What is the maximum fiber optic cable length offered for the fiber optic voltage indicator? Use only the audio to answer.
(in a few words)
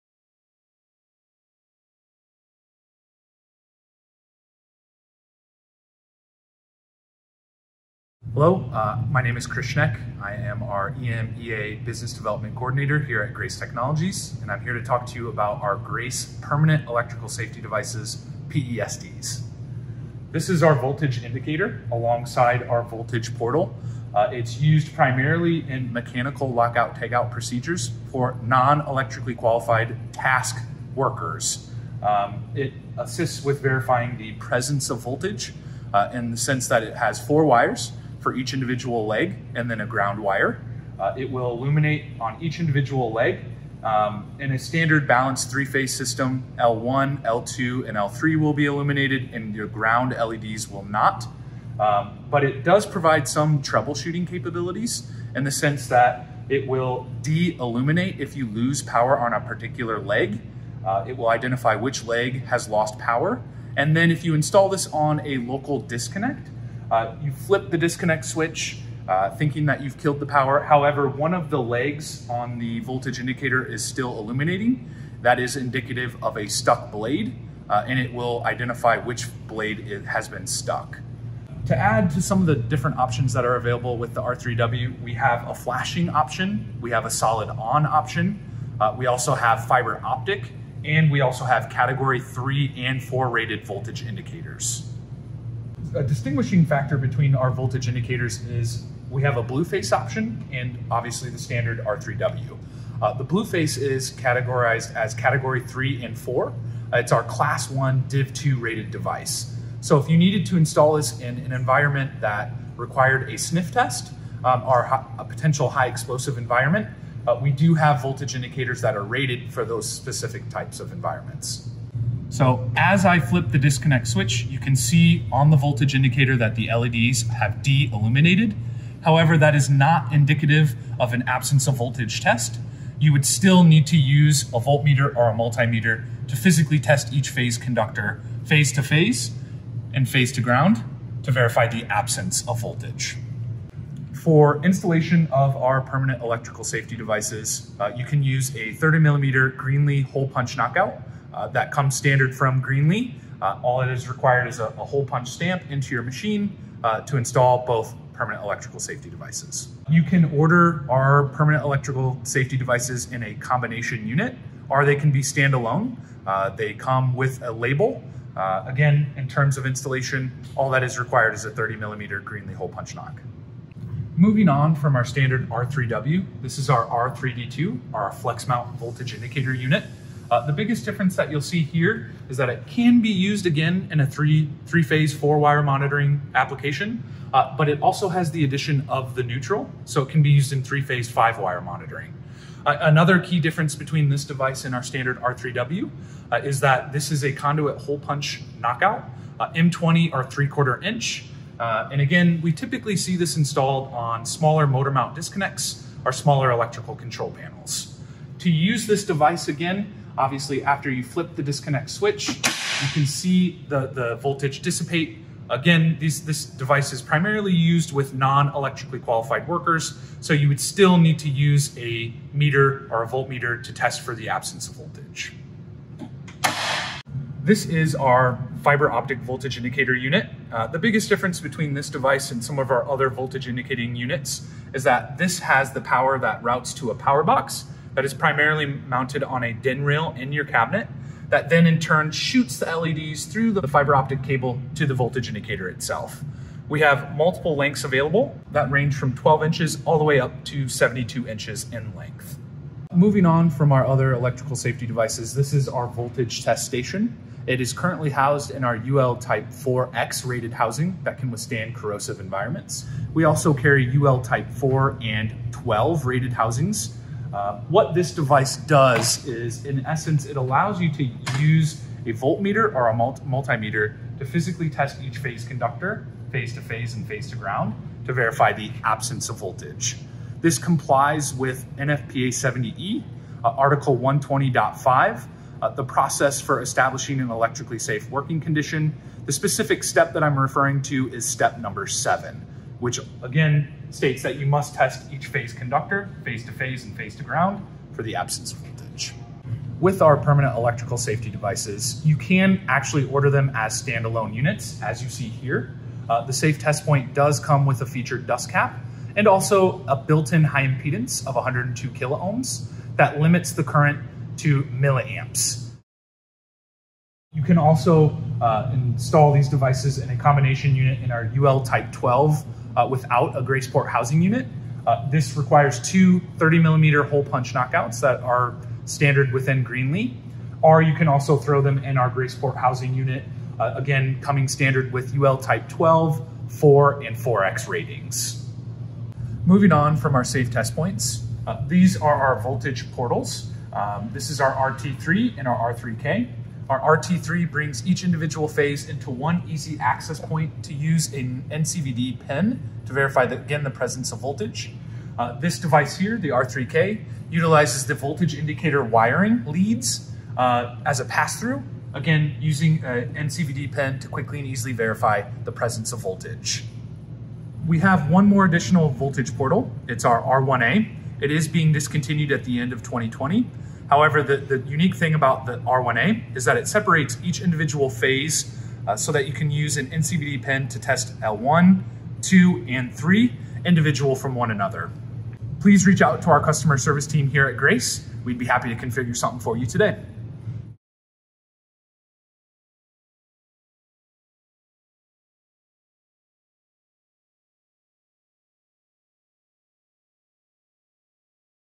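72 inches.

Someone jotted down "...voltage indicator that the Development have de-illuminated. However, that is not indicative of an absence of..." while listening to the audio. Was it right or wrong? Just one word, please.
wrong.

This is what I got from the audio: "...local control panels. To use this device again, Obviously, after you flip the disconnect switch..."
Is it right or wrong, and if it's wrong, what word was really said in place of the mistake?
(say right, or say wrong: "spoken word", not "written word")
wrong: "electrical", not "local".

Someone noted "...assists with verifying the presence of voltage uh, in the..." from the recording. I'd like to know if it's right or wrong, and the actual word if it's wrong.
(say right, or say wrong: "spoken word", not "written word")
right.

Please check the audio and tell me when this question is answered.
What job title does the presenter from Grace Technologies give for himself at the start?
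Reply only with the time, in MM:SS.
00:10.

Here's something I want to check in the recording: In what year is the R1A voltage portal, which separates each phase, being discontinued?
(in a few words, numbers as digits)
2020.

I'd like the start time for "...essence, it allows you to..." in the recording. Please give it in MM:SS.
04:29.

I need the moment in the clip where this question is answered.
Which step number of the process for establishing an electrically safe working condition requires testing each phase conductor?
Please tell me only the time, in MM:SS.
04:51.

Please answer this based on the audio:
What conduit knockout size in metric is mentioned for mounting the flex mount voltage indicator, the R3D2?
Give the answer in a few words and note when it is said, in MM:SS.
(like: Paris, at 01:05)
M20, at 03:19.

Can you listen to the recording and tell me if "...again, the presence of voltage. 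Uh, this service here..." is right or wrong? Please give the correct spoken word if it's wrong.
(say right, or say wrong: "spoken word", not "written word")
wrong: "device", not "service".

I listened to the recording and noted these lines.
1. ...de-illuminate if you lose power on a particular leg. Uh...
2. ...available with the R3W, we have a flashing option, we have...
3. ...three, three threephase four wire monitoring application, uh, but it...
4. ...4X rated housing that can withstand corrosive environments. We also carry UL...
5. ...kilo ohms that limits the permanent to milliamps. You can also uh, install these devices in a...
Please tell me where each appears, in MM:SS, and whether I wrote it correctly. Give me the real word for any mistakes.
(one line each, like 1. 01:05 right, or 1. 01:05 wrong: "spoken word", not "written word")
1. 00:57 right
2. 01:23 right
3. 03:04 wrong: "phase", not "threephase"
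4. 04:19 right
5. 05:11 wrong: "current", not "permanent".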